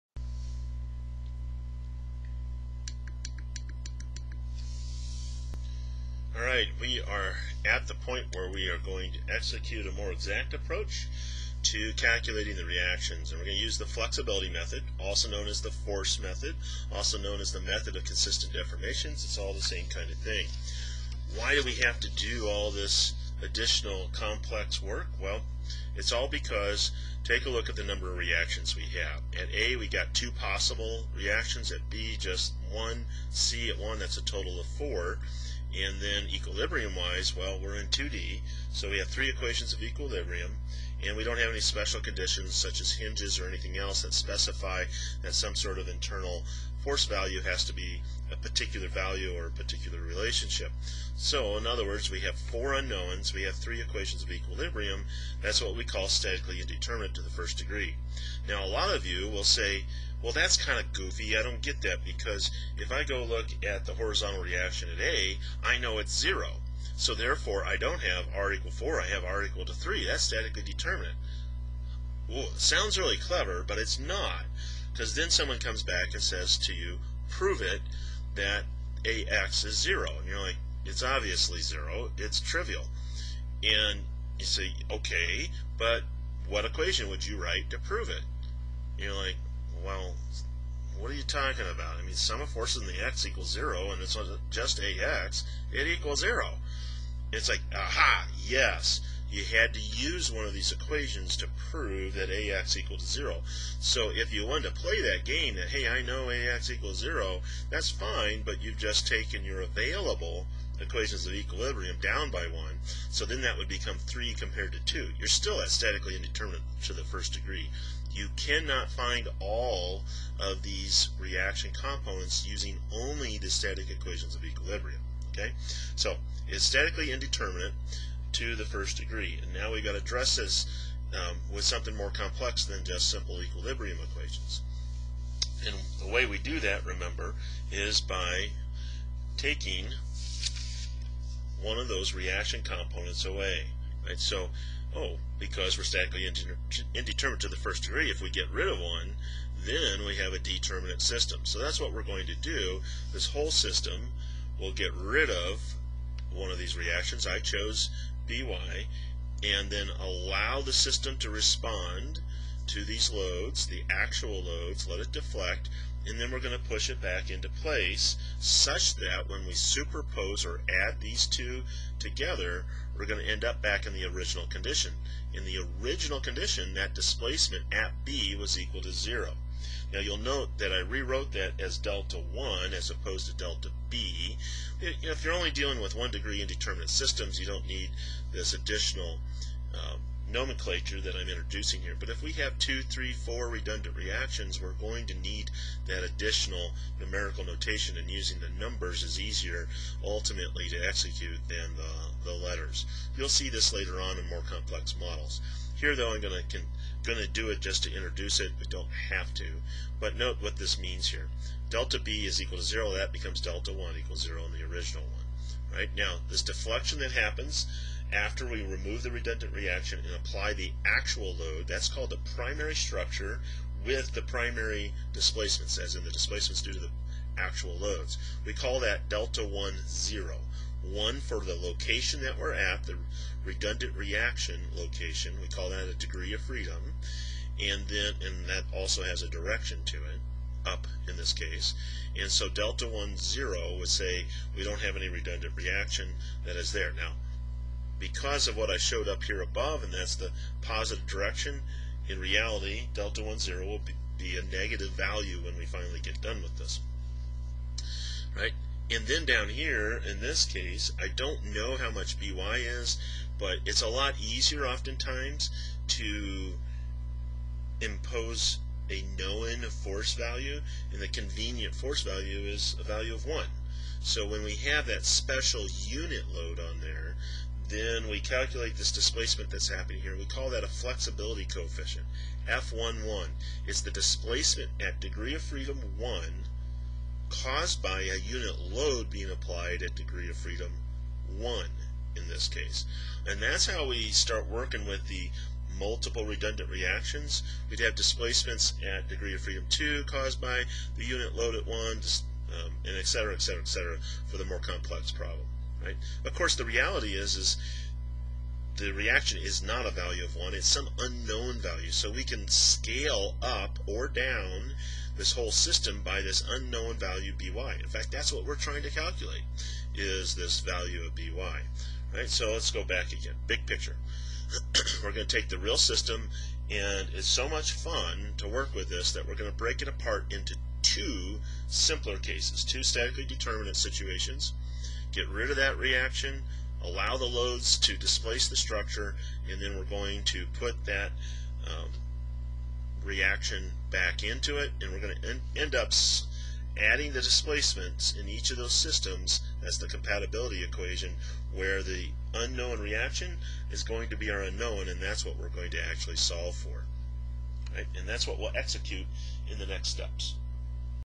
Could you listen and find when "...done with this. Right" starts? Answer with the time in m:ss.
4:16.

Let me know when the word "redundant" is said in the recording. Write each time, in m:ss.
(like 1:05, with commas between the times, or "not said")
3:13, 3:39, 3:53, 4:05, 4:56.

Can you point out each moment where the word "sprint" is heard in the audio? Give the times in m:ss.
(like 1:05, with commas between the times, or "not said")
not said.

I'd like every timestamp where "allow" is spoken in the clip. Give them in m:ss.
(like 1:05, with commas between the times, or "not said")
2:39, 5:36.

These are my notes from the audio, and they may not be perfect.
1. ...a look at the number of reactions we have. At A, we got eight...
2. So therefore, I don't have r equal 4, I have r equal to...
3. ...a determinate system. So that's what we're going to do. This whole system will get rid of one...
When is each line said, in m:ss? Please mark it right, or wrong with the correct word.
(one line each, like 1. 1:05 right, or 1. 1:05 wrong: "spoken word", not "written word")
1. 0:27 wrong: "two", not "eight"
2. 1:06 right
3. 2:30 right.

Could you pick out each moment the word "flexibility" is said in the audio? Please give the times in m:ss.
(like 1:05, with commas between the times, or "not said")
0:13, 4:40.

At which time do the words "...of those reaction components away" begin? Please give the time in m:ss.
2:21.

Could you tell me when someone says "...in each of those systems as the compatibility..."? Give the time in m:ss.
5:48.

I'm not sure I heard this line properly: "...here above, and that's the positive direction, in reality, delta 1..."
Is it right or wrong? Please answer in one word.
right.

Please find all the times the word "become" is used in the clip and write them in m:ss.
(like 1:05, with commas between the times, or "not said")
1:53, 3:33.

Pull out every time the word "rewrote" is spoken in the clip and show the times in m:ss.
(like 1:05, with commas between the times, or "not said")
3:00.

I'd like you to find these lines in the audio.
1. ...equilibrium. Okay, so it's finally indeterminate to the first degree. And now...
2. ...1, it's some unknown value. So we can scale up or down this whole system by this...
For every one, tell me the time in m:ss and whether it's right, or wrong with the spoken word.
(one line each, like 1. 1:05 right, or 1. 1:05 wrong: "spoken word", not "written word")
1. 2:04 wrong: "statically", not "finally"
2. 5:10 right.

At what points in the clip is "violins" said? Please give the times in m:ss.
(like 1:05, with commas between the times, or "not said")
not said.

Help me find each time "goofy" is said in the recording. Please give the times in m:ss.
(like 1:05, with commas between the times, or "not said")
1:00.